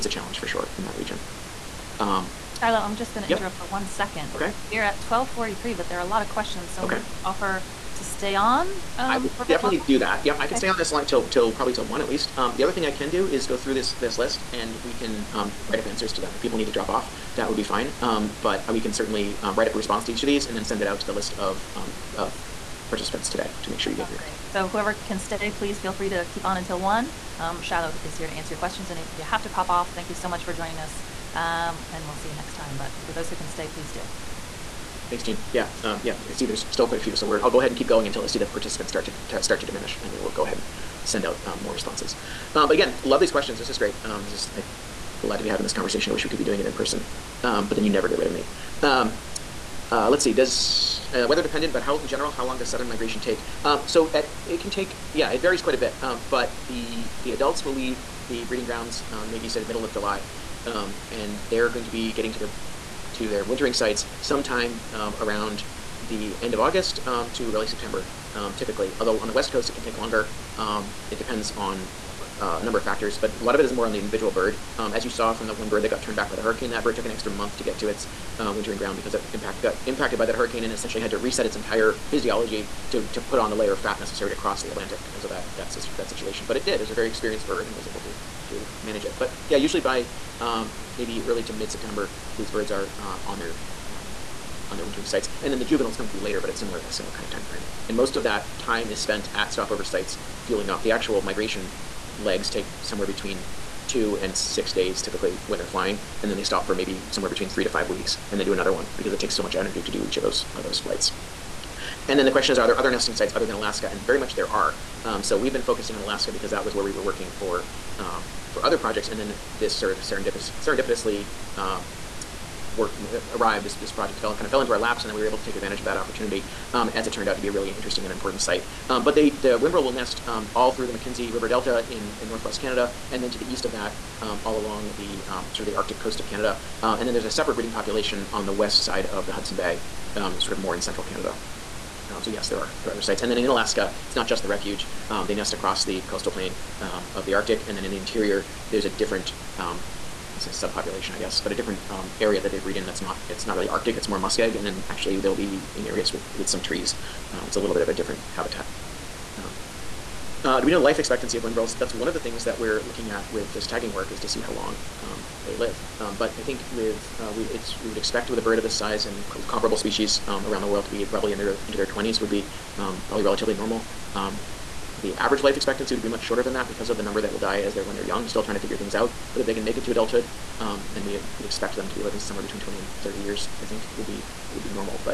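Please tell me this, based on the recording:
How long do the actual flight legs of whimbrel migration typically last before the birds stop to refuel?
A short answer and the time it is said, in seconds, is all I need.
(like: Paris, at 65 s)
2 to 6 days, at 103 s.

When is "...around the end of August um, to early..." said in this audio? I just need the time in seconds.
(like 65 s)
65 s.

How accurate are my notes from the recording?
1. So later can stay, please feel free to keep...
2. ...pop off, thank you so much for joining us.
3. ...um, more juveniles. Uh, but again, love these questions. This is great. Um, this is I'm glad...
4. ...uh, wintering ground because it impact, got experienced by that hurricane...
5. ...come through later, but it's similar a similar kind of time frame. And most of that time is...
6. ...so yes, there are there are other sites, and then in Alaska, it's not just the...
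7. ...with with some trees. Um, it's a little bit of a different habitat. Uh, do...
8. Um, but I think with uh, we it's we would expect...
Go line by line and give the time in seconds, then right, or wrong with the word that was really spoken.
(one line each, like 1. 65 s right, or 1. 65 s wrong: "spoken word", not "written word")
1. 24 s wrong: "whoever", not "later"
2. 29 s right
3. 41 s wrong: "responses", not "juveniles"
4. 78 s wrong: "impacted", not "experienced"
5. 95 s right
6. 142 s right
7. 156 s right
8. 165 s right.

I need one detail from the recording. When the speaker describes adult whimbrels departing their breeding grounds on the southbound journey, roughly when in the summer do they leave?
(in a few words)
middle of July.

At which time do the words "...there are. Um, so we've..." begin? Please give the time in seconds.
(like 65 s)
114 s.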